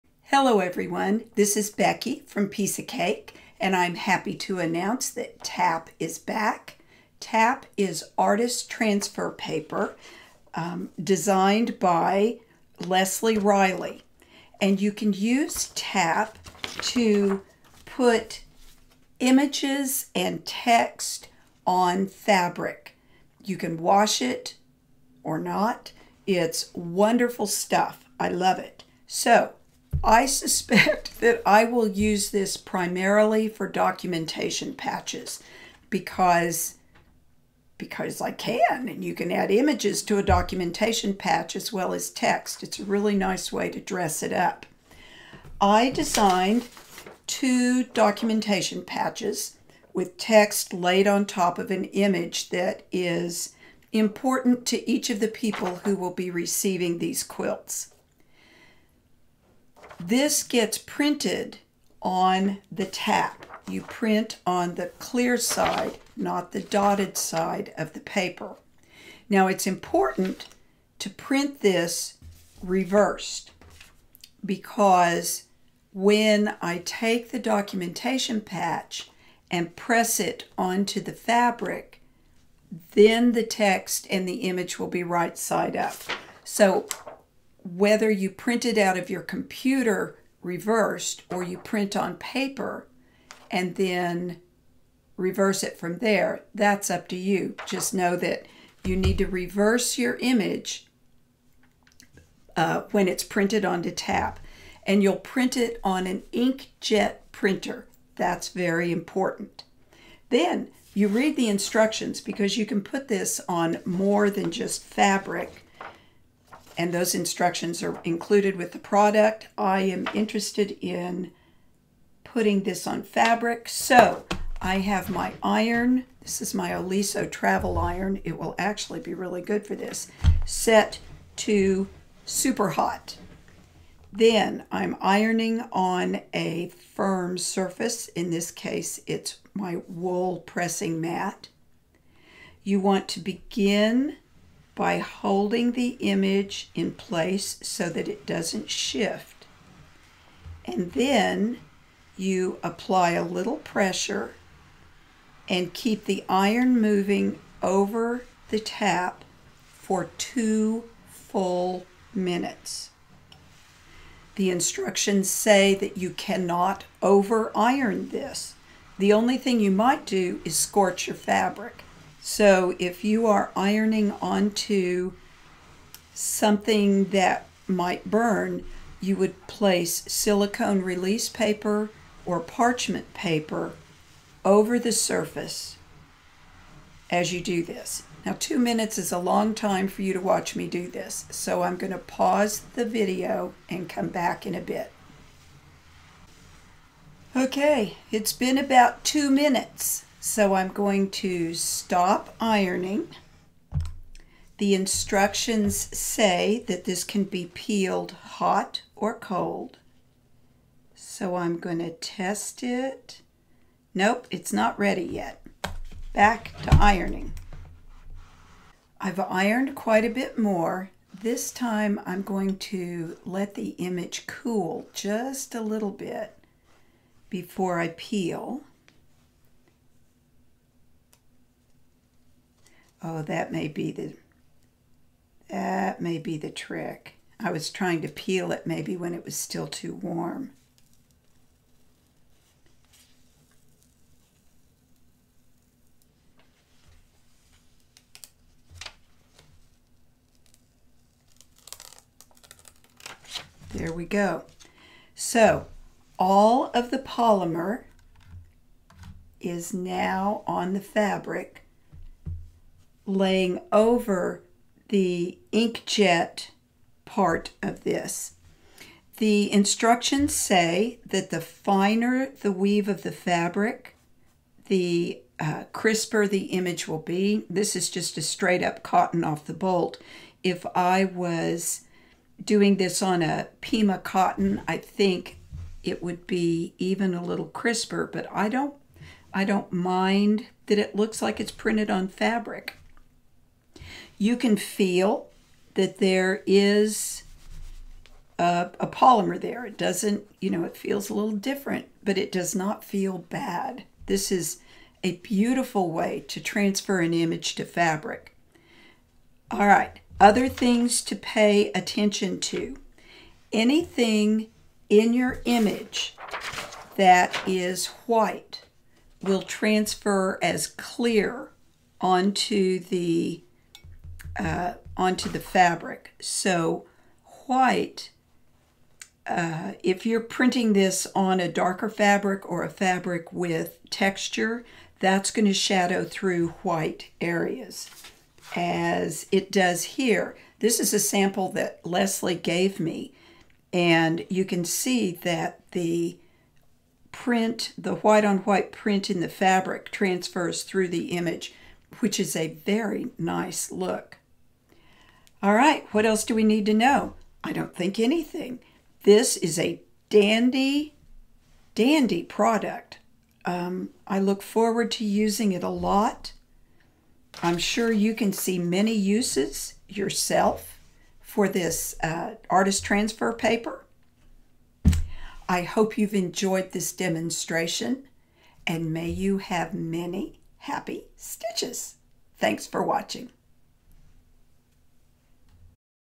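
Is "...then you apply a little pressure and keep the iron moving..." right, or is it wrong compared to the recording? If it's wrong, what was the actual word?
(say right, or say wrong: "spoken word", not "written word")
right.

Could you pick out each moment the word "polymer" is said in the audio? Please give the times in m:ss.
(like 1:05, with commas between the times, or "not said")
4:16, 4:58.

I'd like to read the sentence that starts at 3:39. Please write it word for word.
I've ironed quite a bit more.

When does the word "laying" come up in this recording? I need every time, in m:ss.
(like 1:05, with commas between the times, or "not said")
4:23.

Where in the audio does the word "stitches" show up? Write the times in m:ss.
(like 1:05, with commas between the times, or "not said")
6:21.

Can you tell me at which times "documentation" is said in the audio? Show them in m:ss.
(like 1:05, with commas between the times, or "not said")
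0:33, 0:40, 0:47, 1:17.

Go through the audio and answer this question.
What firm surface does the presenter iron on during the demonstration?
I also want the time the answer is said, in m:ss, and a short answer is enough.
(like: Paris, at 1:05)
Wool pressing mat, at 2:19.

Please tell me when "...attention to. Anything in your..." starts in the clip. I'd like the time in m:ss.
5:11.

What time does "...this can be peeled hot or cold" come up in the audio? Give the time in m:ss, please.
3:26.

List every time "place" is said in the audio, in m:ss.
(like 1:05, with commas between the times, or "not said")
2:26, 2:59.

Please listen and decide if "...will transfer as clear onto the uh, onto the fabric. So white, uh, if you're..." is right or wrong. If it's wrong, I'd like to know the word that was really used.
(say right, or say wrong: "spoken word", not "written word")
right.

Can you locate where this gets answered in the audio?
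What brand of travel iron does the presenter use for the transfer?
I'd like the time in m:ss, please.
2:06.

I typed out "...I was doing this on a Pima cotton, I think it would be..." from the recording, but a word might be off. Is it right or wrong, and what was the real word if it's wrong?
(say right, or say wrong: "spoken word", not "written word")
right.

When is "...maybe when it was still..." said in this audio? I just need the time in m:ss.
3:58.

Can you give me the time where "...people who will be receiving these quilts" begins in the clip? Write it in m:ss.
0:55.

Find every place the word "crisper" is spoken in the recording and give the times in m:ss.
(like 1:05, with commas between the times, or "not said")
4:35, 4:47.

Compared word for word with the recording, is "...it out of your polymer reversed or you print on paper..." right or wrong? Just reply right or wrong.
wrong.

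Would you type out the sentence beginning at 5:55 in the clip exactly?
All right, what else do we need to know?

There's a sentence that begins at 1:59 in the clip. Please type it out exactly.
I am interested in putting this on fabric.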